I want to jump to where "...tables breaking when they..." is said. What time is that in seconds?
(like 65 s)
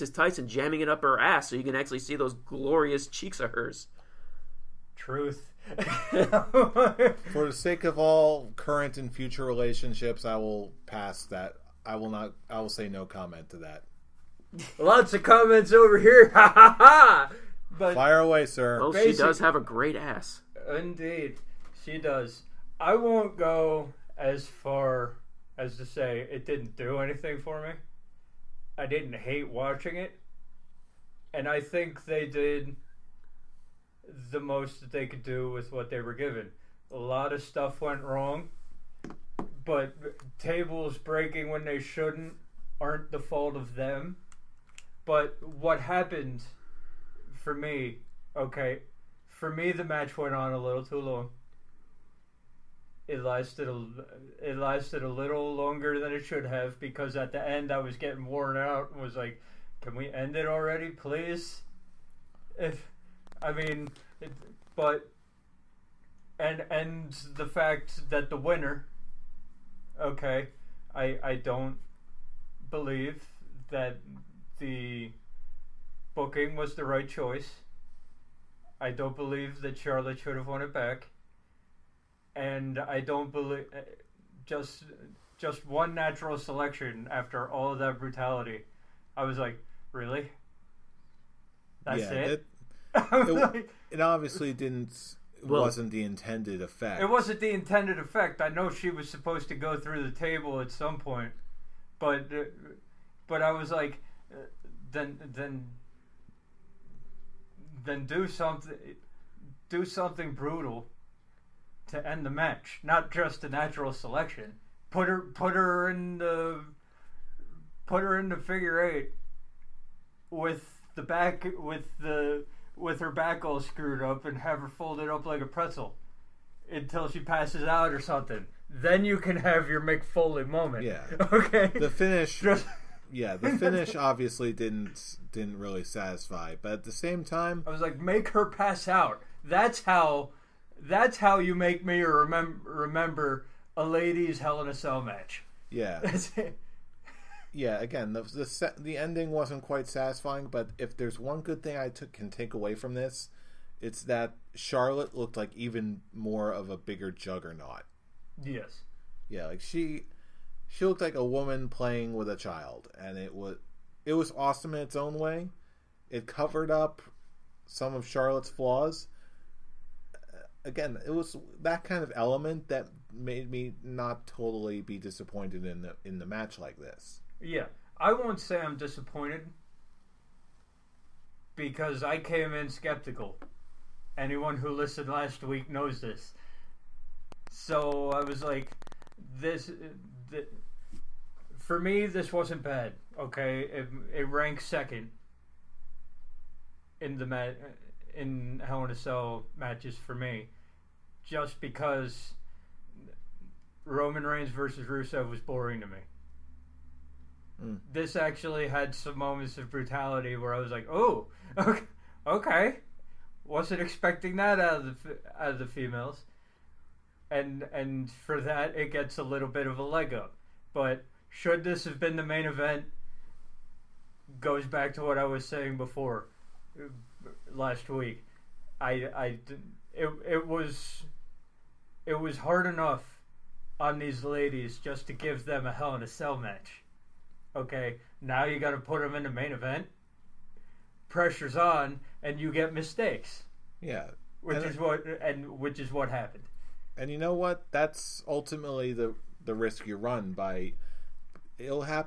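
40 s.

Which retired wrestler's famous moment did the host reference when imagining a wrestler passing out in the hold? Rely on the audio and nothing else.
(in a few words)
Mick Foley.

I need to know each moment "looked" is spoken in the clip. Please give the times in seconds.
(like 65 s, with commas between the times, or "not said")
155 s, 160 s.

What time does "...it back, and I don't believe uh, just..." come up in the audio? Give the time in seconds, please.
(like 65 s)
80 s.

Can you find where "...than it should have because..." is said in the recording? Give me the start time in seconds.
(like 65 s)
55 s.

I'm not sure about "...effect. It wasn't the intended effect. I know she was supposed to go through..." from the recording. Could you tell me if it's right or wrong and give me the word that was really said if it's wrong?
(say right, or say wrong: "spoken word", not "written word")
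right.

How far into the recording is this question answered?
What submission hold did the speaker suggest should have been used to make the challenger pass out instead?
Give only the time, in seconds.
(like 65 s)
118 s.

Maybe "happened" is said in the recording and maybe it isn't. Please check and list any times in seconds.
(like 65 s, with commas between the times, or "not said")
45 s, 246 s.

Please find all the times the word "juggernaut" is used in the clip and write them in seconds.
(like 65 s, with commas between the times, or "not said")
157 s.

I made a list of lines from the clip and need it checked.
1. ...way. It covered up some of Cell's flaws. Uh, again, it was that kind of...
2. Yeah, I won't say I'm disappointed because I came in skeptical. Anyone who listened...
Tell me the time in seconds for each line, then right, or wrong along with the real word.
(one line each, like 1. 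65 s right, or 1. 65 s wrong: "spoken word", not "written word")
1. 165 s wrong: "Charlotte", not "Cell"
2. 177 s right.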